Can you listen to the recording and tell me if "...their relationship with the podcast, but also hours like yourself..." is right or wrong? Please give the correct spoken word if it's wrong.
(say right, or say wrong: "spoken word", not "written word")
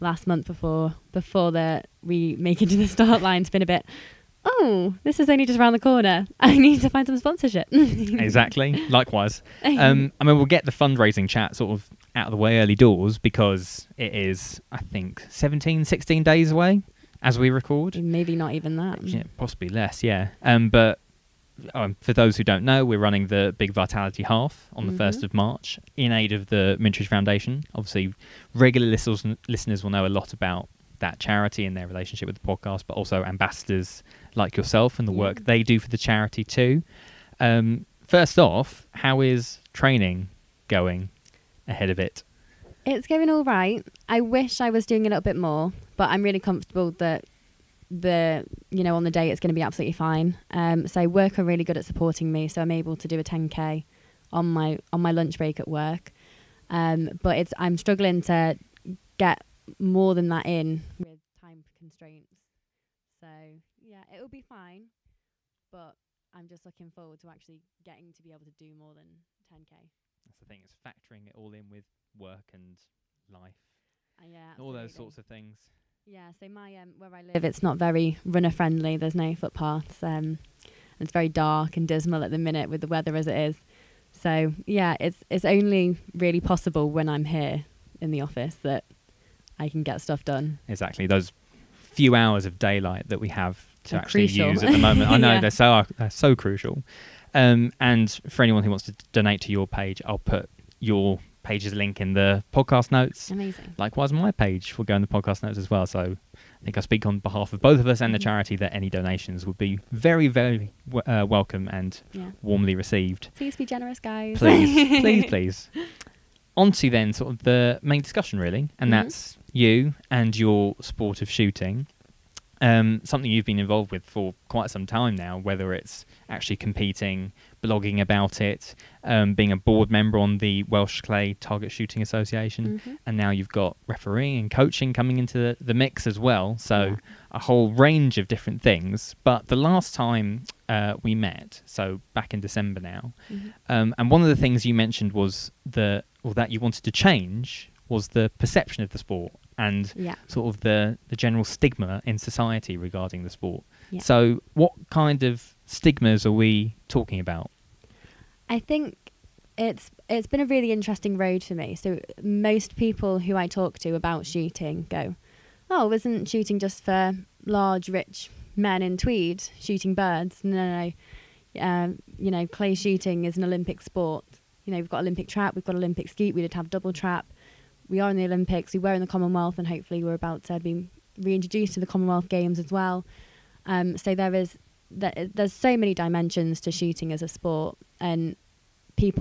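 wrong: "ambassadors", not "hours".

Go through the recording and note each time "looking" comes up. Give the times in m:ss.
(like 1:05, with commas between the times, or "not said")
1:06.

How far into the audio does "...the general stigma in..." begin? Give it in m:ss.
2:31.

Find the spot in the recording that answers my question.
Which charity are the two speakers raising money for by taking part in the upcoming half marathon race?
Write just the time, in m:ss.
0:26.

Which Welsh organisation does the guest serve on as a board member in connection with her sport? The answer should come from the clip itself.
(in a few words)
Welsh Clay Target Shooting Association.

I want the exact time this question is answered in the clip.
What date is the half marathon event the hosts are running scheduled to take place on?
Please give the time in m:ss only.
0:25.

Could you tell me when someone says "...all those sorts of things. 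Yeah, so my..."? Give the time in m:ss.
1:14.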